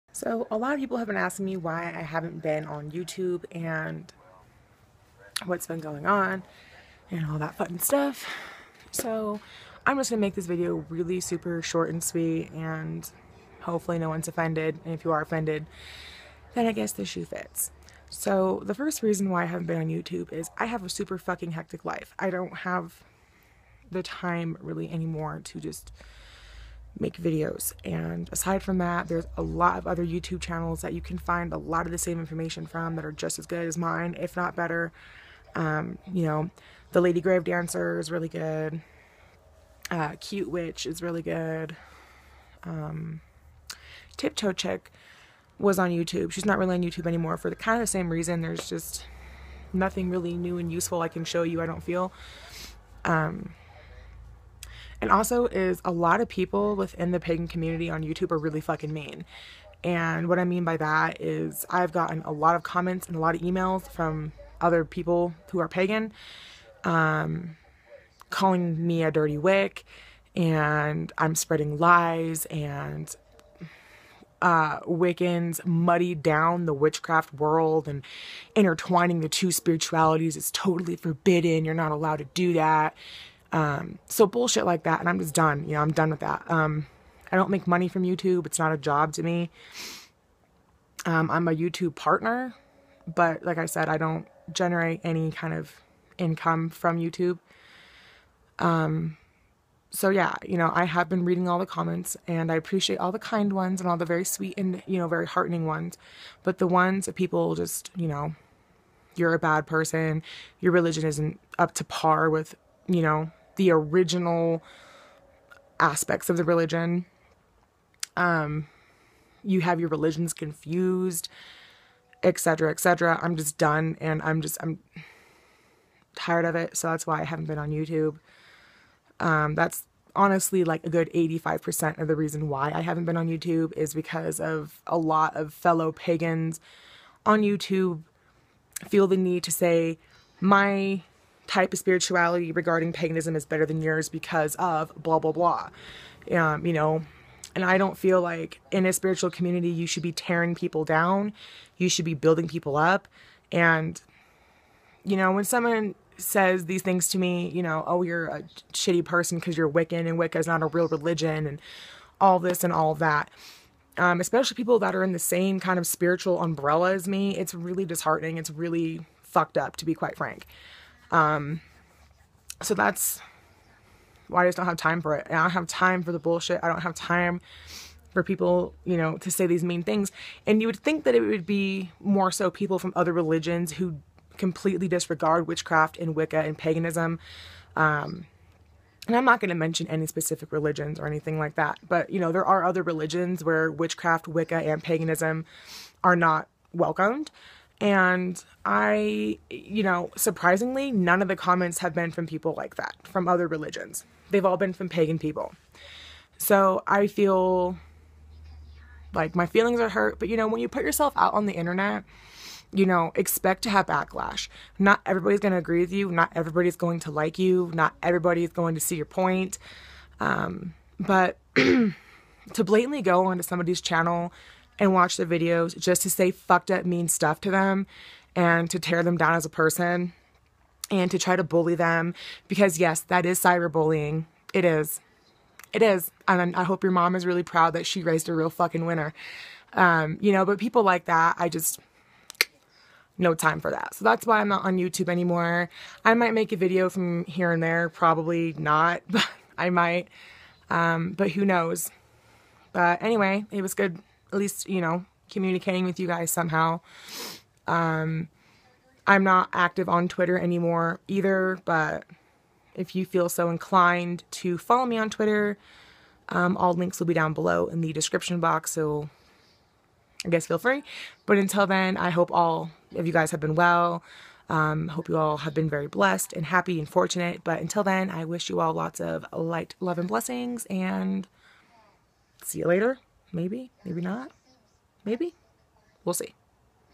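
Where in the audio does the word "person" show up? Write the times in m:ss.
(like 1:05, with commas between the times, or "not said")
1:49, 2:39, 3:49.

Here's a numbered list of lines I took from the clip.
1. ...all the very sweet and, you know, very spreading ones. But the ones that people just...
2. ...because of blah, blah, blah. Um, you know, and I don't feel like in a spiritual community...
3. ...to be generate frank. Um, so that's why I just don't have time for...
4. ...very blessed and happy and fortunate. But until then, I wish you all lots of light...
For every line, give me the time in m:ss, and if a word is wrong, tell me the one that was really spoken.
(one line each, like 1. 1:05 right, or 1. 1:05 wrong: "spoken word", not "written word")
1. 1:43 wrong: "heartening", not "spreading"
2. 2:24 right
3. 2:49 wrong: "quite", not "generate"
4. 4:35 right.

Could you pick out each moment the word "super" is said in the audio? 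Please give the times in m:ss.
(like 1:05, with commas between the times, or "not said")
0:11, 0:20.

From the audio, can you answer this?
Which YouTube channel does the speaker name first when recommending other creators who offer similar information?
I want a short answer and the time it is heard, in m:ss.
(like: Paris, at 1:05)
The Lady Grave Dancer, at 0:36.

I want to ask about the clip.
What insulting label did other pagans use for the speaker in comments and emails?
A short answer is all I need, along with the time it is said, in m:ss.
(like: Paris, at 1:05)
dirty wick, at 1:09.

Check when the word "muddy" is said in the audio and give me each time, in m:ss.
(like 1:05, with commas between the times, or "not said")
1:15.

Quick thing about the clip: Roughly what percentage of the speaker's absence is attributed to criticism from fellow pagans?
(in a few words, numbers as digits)
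85%.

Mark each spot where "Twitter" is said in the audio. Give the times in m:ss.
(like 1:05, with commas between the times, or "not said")
4:20, 4:25.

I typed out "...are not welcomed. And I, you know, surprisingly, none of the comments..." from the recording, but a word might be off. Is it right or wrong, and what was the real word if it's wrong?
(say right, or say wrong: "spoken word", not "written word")
right.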